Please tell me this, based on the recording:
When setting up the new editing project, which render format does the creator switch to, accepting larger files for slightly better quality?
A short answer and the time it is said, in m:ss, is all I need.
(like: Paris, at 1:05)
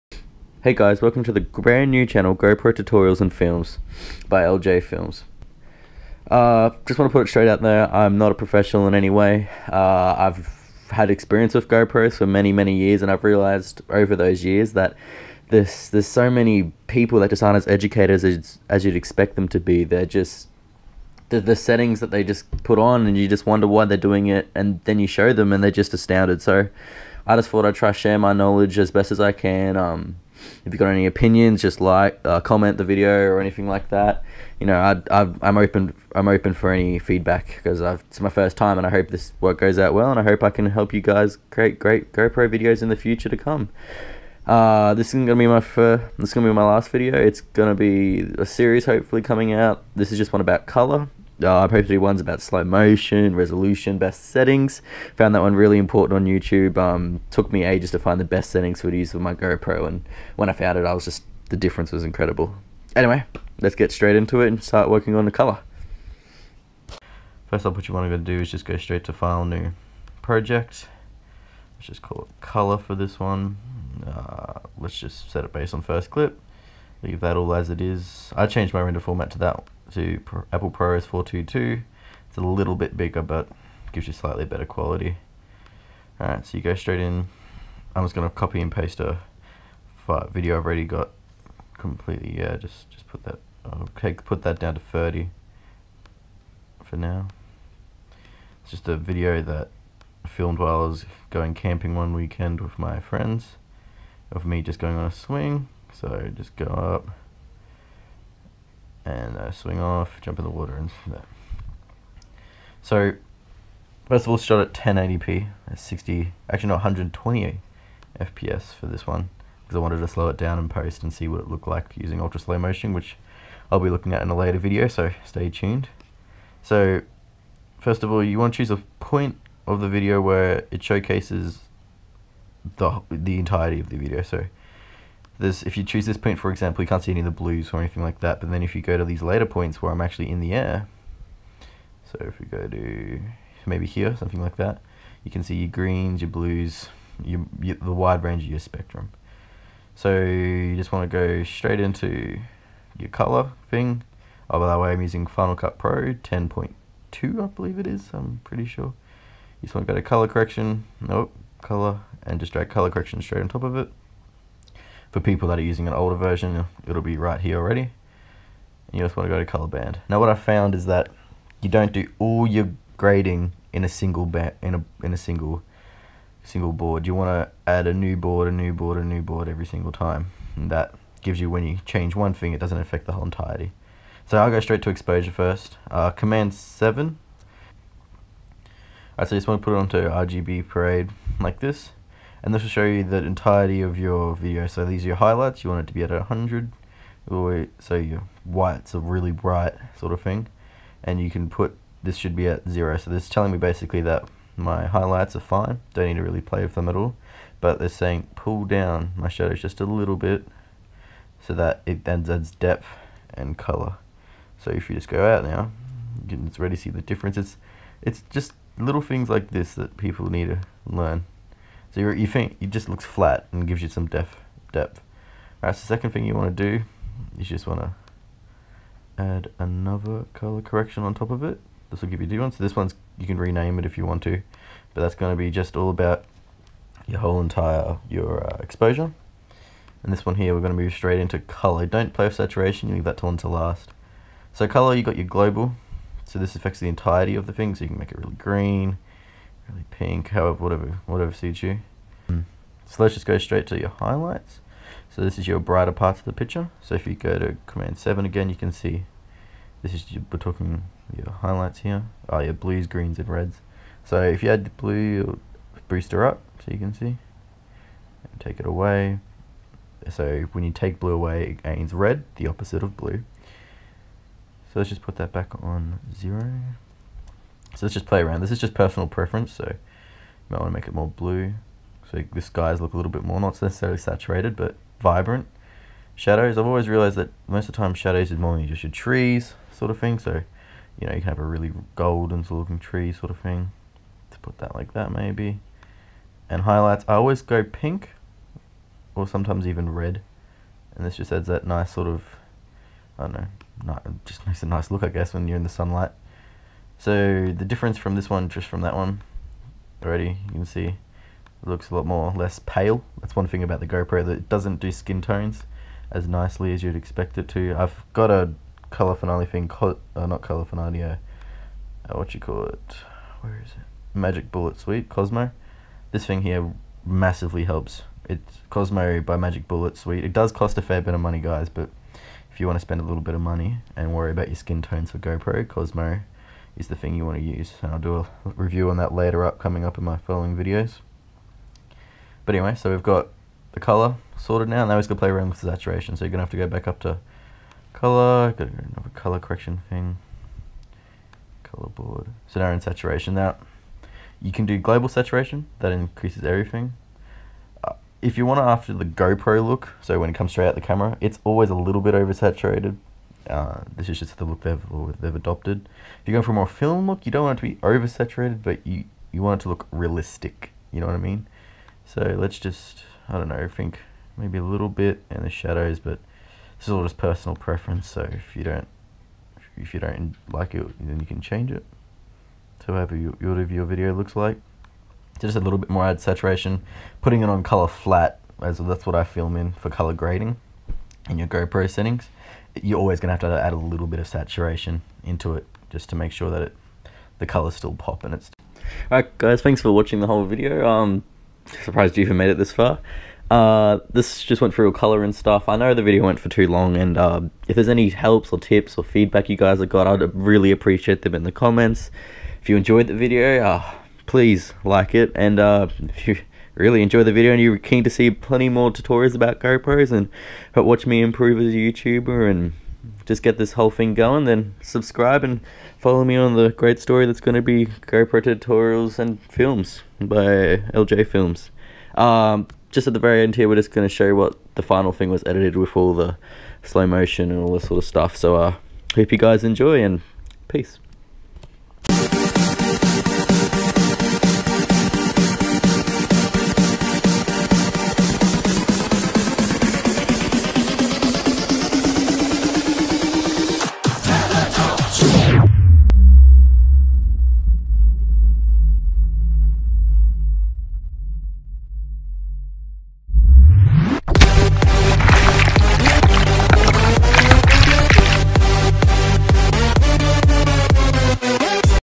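Apple ProRes 422, at 1:20.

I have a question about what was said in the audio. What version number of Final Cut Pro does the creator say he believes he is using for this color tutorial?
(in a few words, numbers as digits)
10.2.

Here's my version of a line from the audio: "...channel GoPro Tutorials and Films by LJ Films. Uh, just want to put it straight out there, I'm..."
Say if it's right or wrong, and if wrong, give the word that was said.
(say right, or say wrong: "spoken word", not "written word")
right.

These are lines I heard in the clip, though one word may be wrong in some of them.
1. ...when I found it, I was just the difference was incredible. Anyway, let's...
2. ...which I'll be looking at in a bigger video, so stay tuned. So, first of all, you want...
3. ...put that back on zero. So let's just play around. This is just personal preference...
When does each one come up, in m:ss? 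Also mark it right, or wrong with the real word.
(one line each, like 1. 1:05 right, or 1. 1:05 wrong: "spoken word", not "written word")
1. 1:00 right
2. 2:02 wrong: "later", not "bigger"
3. 4:35 right.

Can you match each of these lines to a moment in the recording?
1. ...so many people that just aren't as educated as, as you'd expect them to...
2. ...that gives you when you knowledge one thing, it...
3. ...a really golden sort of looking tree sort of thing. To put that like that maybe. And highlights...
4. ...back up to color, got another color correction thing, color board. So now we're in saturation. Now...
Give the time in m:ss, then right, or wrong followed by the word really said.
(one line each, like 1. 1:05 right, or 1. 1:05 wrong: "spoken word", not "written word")
1. 0:16 right
2. 3:00 wrong: "change", not "knowledge"
3. 4:51 right
4. 5:46 right.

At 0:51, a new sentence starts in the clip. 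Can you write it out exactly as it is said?
Uh, probably do ones about slow motion, resolution, best settings.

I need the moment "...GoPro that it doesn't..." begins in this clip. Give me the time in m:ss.
5:13.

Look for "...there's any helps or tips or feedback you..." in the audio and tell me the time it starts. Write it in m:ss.
6:47.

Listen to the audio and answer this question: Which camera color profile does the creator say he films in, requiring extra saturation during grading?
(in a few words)
Color flat.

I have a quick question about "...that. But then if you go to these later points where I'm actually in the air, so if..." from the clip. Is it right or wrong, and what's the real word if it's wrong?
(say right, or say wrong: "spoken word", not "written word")
right.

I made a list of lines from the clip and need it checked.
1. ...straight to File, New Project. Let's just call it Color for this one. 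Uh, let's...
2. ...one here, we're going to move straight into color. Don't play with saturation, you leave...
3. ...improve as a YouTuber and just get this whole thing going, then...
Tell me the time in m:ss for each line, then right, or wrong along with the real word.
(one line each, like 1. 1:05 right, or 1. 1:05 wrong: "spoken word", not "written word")
1. 1:08 right
2. 4:00 right
3. 7:01 right.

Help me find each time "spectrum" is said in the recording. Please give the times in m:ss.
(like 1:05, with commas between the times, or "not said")
2:28.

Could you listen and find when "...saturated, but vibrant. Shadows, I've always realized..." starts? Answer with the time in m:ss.
4:43.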